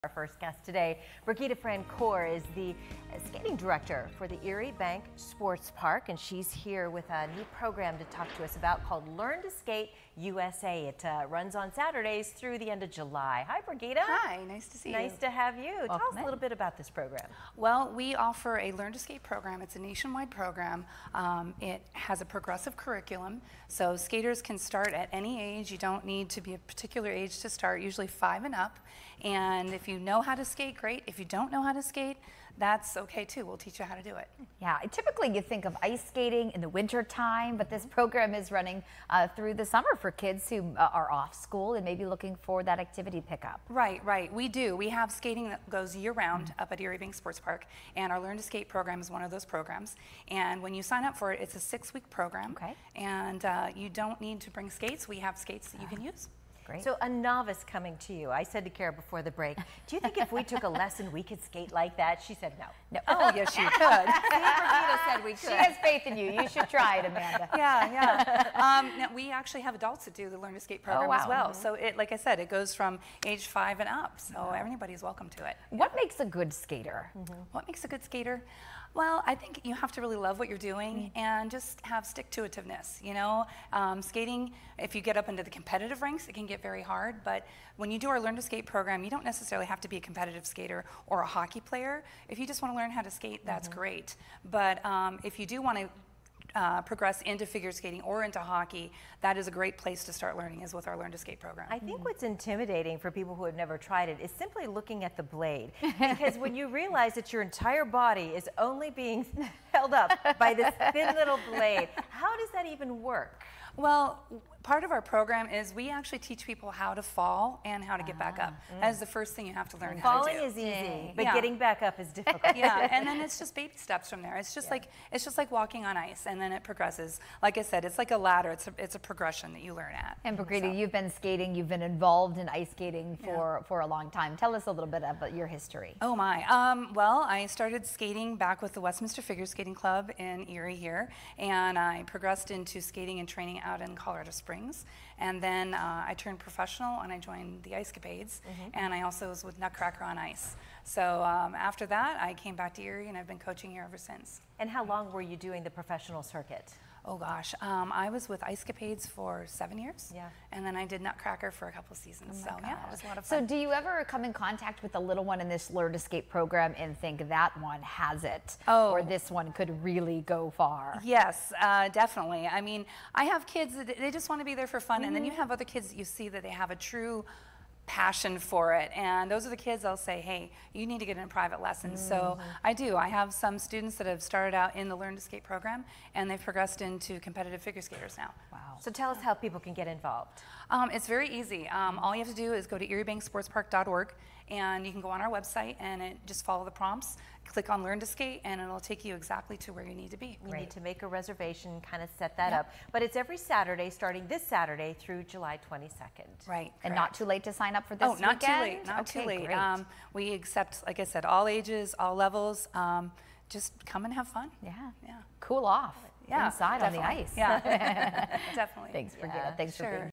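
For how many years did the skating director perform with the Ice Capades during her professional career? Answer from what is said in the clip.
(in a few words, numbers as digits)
7.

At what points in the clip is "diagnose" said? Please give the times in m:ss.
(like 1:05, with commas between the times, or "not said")
not said.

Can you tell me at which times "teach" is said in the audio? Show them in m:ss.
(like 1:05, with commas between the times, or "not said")
0:33, 1:56.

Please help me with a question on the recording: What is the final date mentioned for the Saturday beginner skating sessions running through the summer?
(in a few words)
July 22.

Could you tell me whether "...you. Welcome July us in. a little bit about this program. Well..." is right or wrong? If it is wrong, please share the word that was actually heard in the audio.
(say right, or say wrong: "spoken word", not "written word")
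wrong: "Tell", not "July".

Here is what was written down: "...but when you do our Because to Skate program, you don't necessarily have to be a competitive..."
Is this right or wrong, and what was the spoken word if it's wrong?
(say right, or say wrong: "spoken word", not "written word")
wrong: "Learn", not "Because".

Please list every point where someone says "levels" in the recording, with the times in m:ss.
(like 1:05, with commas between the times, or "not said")
3:32.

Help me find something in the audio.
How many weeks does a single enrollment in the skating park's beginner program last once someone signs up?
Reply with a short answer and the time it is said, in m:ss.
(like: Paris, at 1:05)
6 weeks, at 0:51.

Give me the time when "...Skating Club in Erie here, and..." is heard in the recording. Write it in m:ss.
2:19.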